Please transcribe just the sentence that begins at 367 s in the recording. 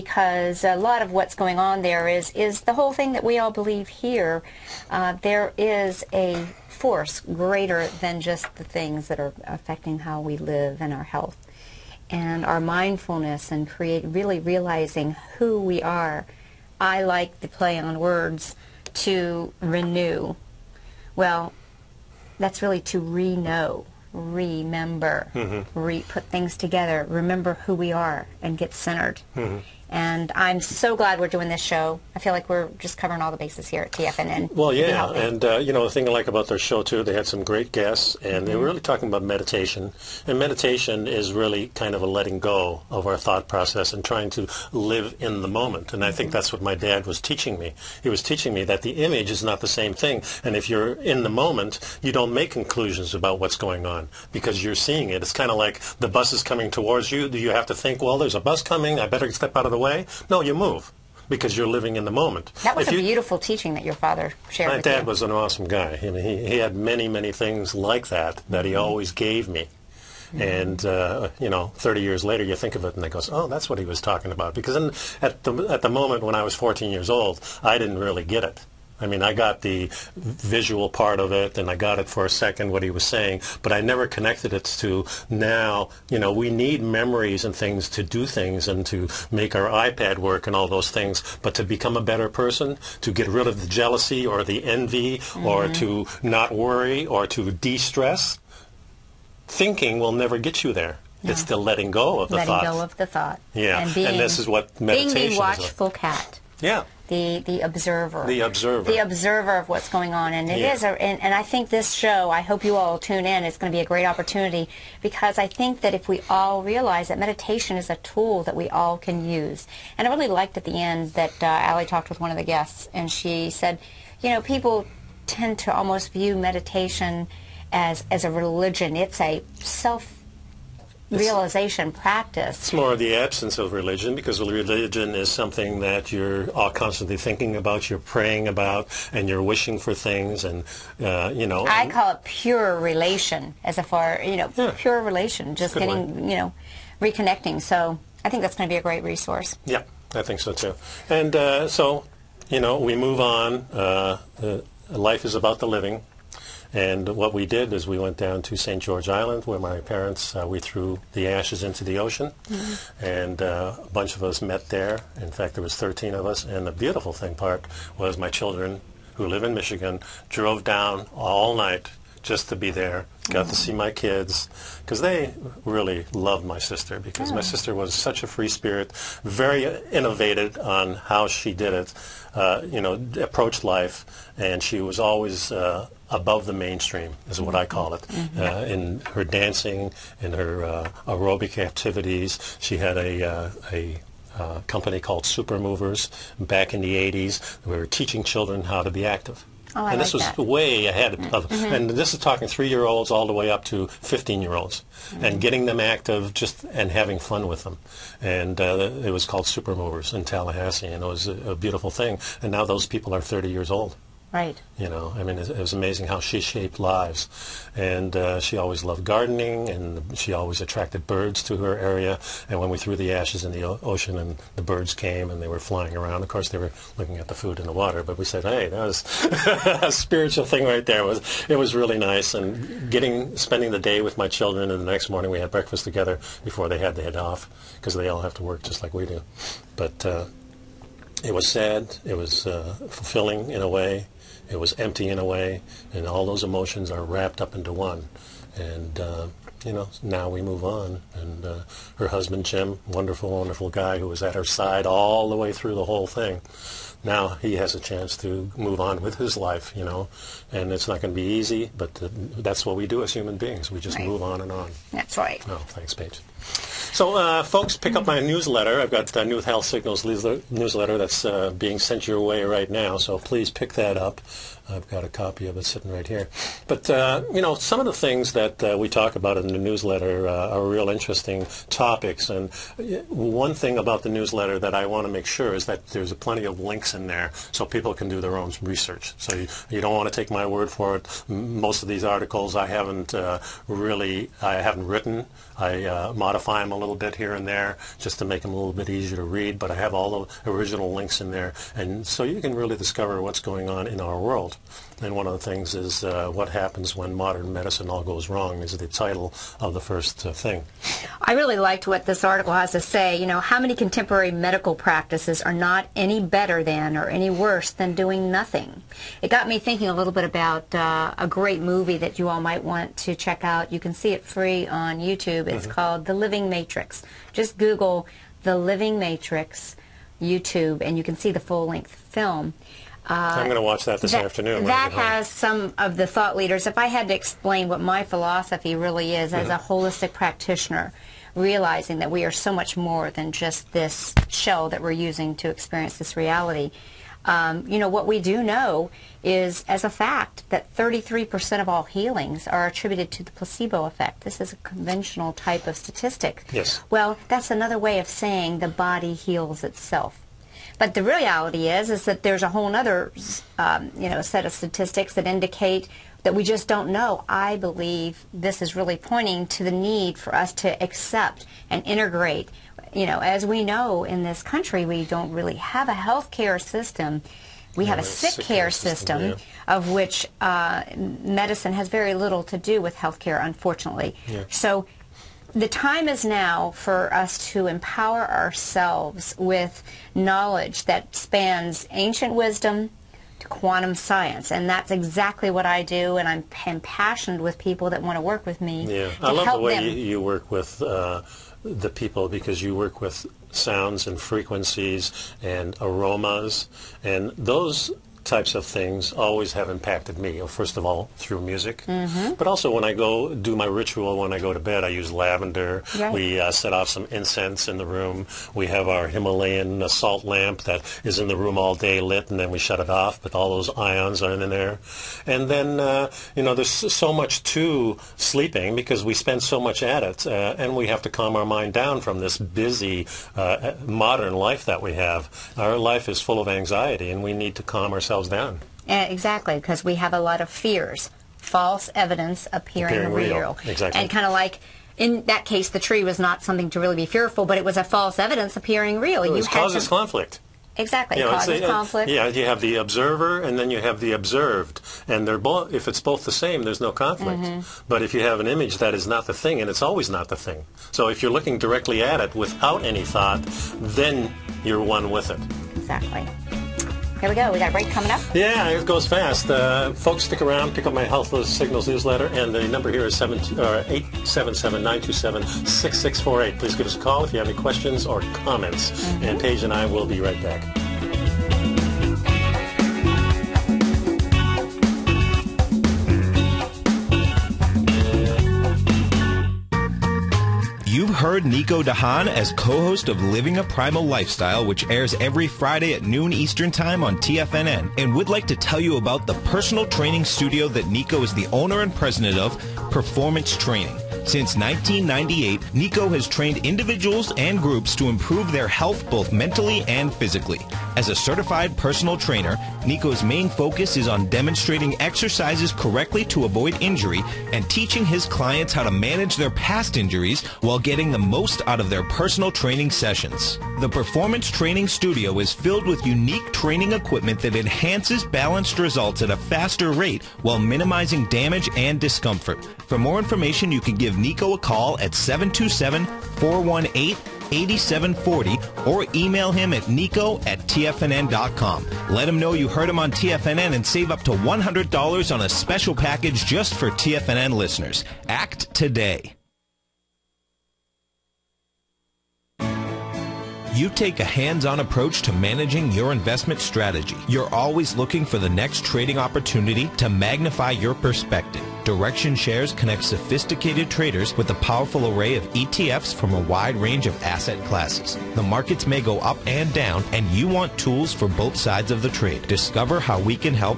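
I believe this is really pointing to the need for us to accept and integrate.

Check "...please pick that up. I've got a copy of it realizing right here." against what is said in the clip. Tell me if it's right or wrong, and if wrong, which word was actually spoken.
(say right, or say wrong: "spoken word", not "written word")
wrong: "sitting", not "realizing".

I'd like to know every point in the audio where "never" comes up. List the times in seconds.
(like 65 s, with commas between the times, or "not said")
83 s, 100 s.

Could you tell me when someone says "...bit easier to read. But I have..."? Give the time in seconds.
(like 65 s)
298 s.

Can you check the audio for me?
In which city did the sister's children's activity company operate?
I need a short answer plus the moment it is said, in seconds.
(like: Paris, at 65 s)
Tallahassee, at 210 s.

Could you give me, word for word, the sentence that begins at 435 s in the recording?
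Our life is full of anxiety, and we need to calm ourselves down.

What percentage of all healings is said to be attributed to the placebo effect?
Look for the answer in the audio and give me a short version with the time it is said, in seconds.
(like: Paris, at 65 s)
33%, at 350 s.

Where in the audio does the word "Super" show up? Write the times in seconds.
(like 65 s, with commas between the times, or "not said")
195 s, 209 s.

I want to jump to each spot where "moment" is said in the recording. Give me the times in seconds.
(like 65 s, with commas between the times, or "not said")
45 s, 51 s, 62 s, 75 s.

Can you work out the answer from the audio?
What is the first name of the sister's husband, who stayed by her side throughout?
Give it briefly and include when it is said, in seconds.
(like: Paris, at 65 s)
Jim, at 252 s.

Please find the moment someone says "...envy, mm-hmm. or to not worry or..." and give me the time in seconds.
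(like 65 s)
94 s.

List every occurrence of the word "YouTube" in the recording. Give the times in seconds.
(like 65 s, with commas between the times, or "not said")
324 s, 330 s.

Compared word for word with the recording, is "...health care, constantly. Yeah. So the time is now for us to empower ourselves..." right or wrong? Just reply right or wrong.
wrong.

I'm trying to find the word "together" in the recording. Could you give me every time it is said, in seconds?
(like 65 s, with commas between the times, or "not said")
26 s, 235 s.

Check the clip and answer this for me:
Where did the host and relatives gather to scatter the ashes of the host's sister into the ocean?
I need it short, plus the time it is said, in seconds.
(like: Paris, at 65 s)
St. George Island, at 158 s.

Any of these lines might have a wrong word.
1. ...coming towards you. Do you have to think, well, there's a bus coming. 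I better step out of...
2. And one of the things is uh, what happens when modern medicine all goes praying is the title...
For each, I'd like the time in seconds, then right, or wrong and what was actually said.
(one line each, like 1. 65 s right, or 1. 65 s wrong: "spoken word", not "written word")
1. 56 s right
2. 304 s wrong: "wrong", not "praying".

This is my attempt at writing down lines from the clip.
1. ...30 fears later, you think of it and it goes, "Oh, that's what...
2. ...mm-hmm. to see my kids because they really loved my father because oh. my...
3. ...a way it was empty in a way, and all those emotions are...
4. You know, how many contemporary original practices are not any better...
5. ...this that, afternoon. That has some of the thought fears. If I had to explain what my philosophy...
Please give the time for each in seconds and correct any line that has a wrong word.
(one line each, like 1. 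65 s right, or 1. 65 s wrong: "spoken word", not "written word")
1. 71 s wrong: "years", not "fears"
2. 173 s wrong: "sister", not "father"
3. 243 s right
4. 313 s wrong: "medical", not "original"
5. 334 s wrong: "leaders", not "fears".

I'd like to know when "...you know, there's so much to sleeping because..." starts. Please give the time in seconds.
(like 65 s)
426 s.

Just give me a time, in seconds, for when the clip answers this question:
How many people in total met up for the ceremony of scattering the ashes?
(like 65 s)
165 s.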